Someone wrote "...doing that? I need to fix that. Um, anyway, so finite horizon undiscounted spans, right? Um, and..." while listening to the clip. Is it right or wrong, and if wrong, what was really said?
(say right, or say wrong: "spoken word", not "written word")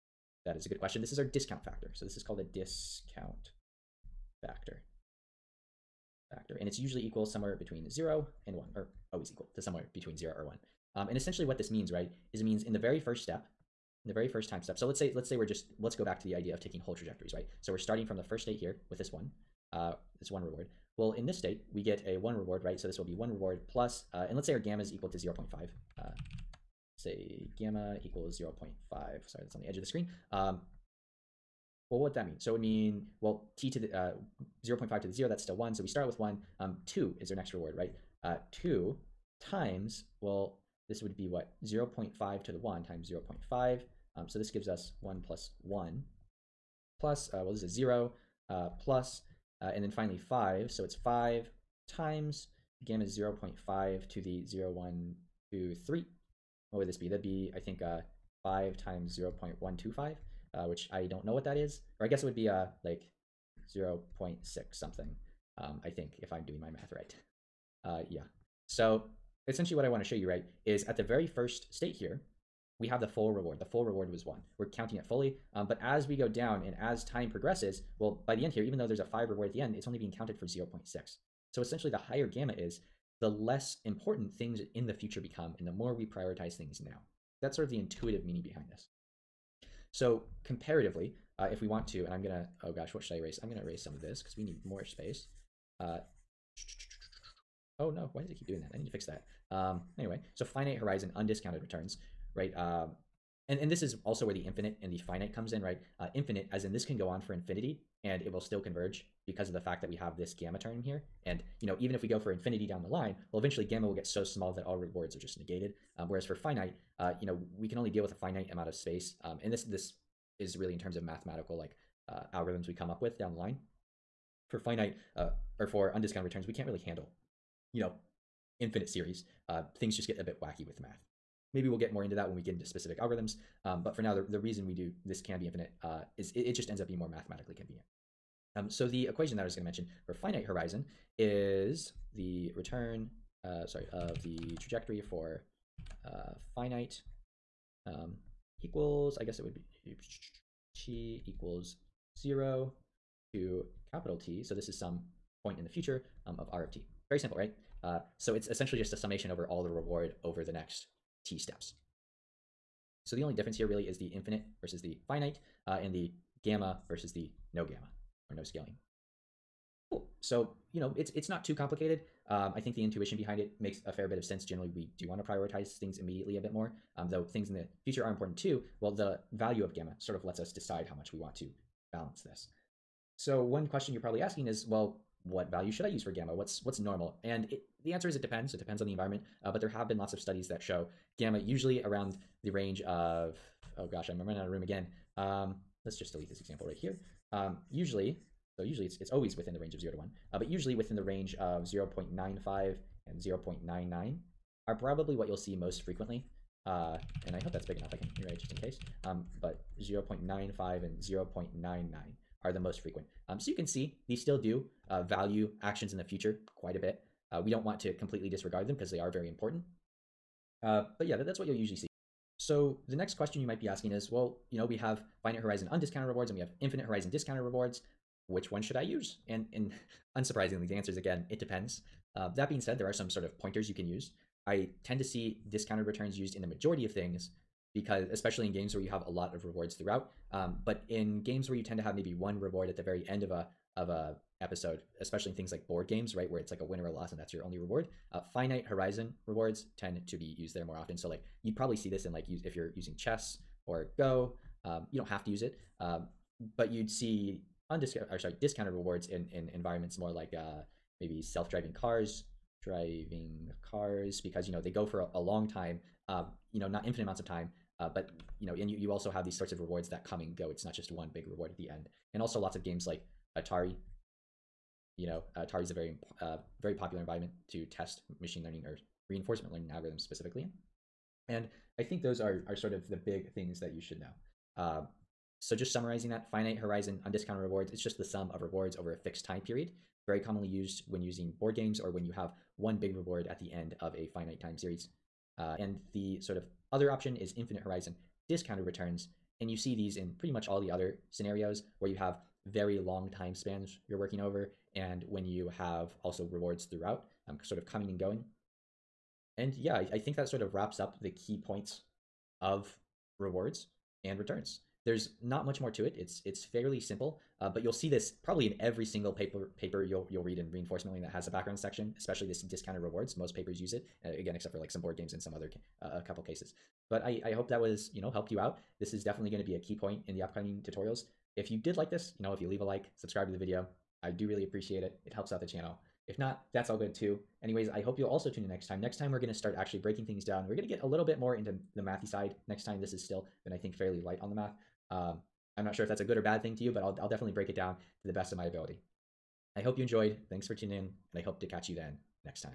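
wrong: "returns", not "spans".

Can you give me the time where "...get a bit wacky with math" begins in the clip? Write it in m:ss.
2:10.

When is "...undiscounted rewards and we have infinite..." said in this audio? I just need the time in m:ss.
3:45.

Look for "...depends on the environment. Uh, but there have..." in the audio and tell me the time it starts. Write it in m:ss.
3:08.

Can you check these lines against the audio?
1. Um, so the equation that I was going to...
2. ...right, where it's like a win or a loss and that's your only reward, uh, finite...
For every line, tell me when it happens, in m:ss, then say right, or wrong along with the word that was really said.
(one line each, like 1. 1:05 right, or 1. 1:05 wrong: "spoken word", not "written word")
1. 2:18 right
2. 4:06 right.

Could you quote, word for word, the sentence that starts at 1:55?
Um, whereas for finite, uh, you know, we can only deal with a finite amount of space.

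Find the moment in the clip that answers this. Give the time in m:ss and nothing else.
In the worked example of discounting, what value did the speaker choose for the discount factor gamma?
0:27.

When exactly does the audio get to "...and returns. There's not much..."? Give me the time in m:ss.
5:14.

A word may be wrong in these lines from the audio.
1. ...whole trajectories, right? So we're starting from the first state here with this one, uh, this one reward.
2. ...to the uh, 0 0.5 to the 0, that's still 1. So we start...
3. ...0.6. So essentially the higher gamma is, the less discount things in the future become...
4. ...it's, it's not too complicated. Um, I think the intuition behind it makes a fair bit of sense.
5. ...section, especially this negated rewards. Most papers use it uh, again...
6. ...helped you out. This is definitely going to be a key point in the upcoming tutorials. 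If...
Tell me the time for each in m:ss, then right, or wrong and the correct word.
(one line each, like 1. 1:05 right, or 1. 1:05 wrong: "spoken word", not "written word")
1. 0:16 right
2. 0:33 right
3. 1:20 wrong: "important", not "discount"
4. 2:50 right
5. 5:21 wrong: "discounted", not "negated"
6. 5:28 right.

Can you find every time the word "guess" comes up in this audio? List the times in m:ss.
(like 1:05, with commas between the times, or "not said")
1:02, 2:29.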